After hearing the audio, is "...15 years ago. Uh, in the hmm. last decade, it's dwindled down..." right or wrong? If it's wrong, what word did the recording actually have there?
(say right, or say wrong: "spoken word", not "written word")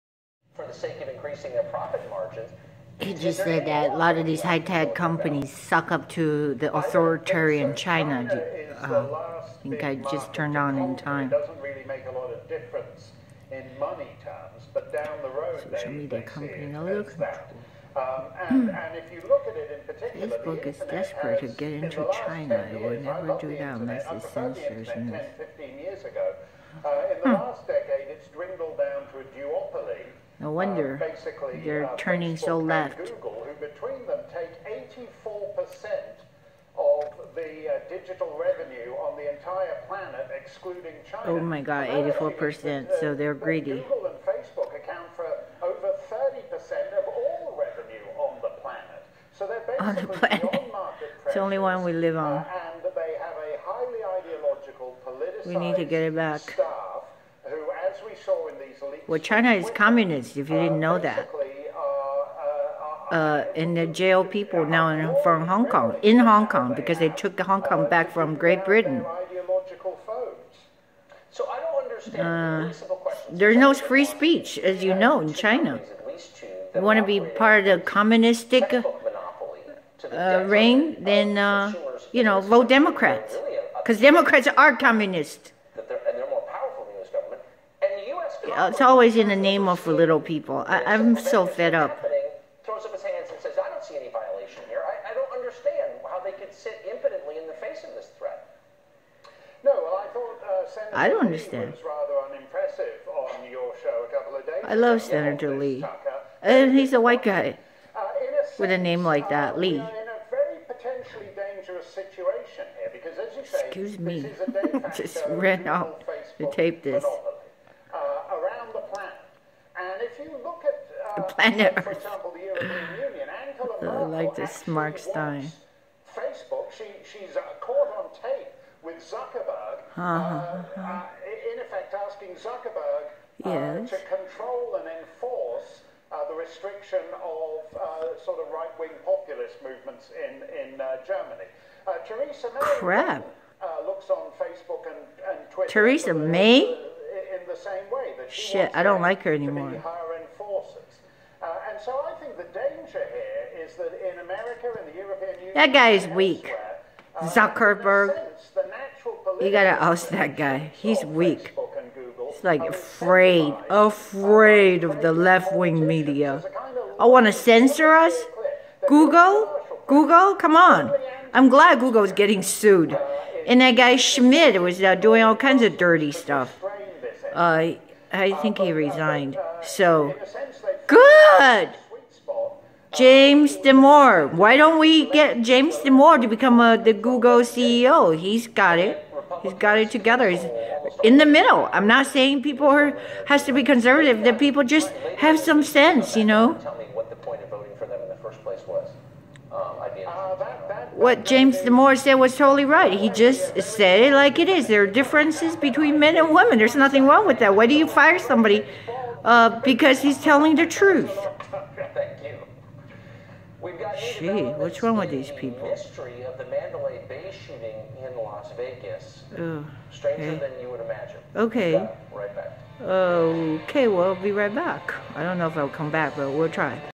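right.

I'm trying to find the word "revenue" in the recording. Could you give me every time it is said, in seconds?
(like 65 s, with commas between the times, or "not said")
38 s, 47 s.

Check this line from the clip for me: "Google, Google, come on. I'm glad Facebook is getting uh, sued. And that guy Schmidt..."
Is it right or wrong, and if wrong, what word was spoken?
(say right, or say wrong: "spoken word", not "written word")
wrong: "Google", not "Facebook".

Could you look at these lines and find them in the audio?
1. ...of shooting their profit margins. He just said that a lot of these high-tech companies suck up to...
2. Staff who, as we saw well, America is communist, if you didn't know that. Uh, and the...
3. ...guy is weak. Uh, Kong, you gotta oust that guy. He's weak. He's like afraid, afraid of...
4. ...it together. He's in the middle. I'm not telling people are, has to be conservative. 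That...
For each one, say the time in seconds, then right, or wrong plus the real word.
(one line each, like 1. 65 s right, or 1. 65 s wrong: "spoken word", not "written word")
1. 1 s wrong: "increasing", not "shooting"
2. 56 s wrong: "China", not "America"
3. 155 s wrong: "Zuckerberg", not "Kong"
4. 189 s wrong: "saying", not "telling".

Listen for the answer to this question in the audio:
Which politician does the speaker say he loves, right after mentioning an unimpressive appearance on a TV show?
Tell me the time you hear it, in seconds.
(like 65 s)
105 s.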